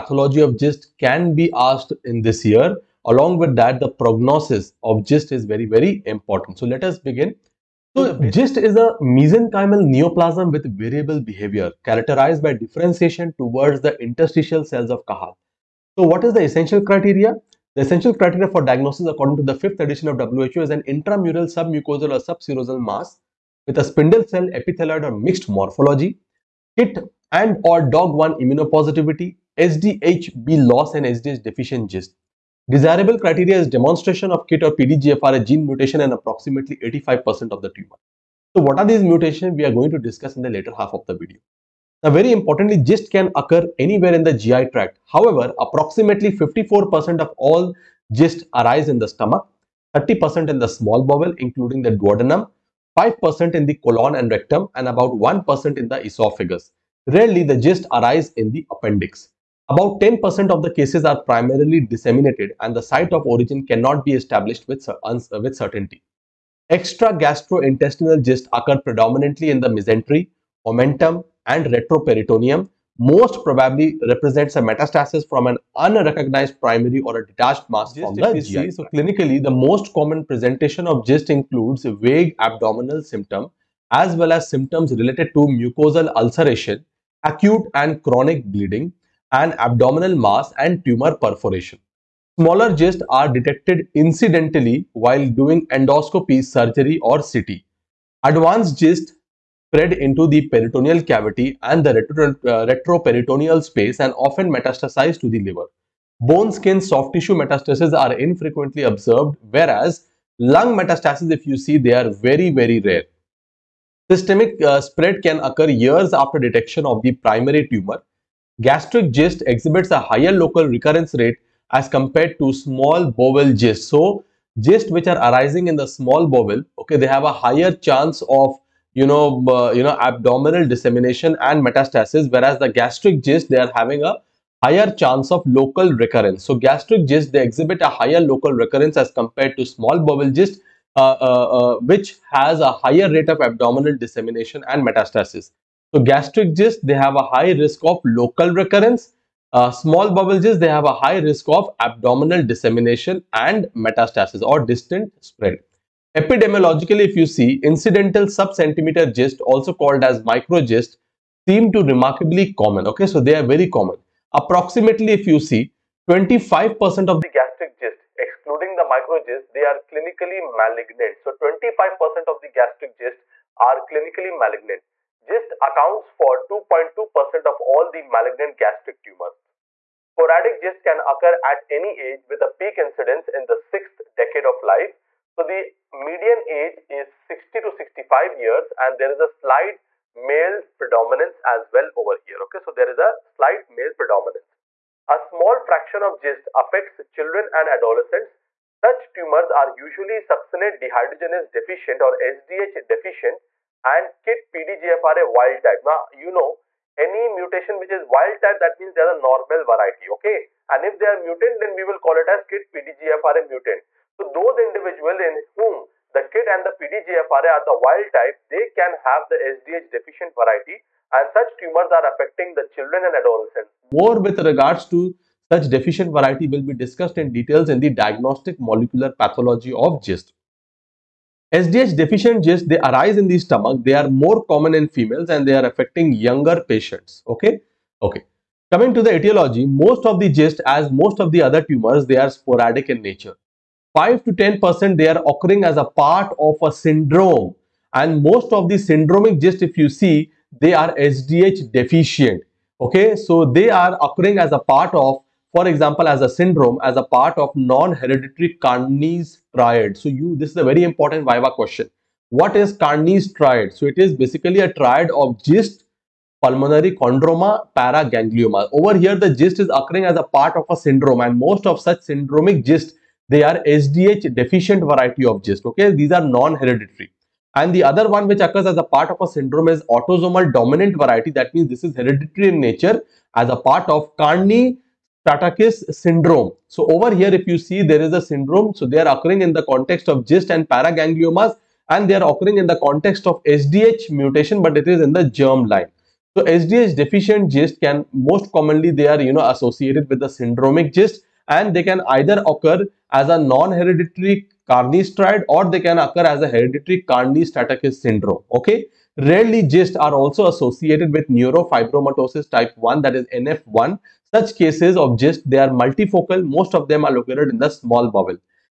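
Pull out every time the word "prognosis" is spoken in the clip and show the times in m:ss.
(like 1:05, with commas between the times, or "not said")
0:04.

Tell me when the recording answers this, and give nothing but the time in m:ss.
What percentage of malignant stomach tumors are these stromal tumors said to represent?
2:56.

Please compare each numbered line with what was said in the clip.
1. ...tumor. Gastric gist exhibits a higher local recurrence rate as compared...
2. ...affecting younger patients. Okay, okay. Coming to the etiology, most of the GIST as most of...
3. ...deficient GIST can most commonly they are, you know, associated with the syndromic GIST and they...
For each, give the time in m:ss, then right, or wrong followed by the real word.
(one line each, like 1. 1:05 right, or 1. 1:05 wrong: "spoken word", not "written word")
1. 1:57 right
2. 3:55 right
3. 4:56 right.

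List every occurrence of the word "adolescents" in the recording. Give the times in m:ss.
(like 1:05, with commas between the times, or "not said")
3:17, 3:43.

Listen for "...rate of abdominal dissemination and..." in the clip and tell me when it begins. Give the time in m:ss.
2:23.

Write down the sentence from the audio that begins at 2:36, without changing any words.
Epidemiologically, if you see, incidental sub-centimeter gist, also called as microgist, seem to remarkably common.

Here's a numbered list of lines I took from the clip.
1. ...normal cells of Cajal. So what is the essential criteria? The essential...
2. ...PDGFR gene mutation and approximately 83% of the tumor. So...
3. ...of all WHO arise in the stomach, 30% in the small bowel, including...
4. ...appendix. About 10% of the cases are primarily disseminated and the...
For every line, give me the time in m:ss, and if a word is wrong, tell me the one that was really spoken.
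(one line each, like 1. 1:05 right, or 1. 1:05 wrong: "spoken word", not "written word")
1. 0:14 wrong: "interstitial", not "normal"
2. 0:34 wrong: "85", not "83"
3. 0:47 wrong: "GIST", not "WHO"
4. 0:58 right.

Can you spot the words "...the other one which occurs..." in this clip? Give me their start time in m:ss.
4:37.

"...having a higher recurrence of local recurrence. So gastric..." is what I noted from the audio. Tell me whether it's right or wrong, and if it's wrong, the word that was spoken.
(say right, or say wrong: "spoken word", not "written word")
wrong: "chance", not "recurrence".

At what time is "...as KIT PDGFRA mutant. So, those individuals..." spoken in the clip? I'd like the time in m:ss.
3:32.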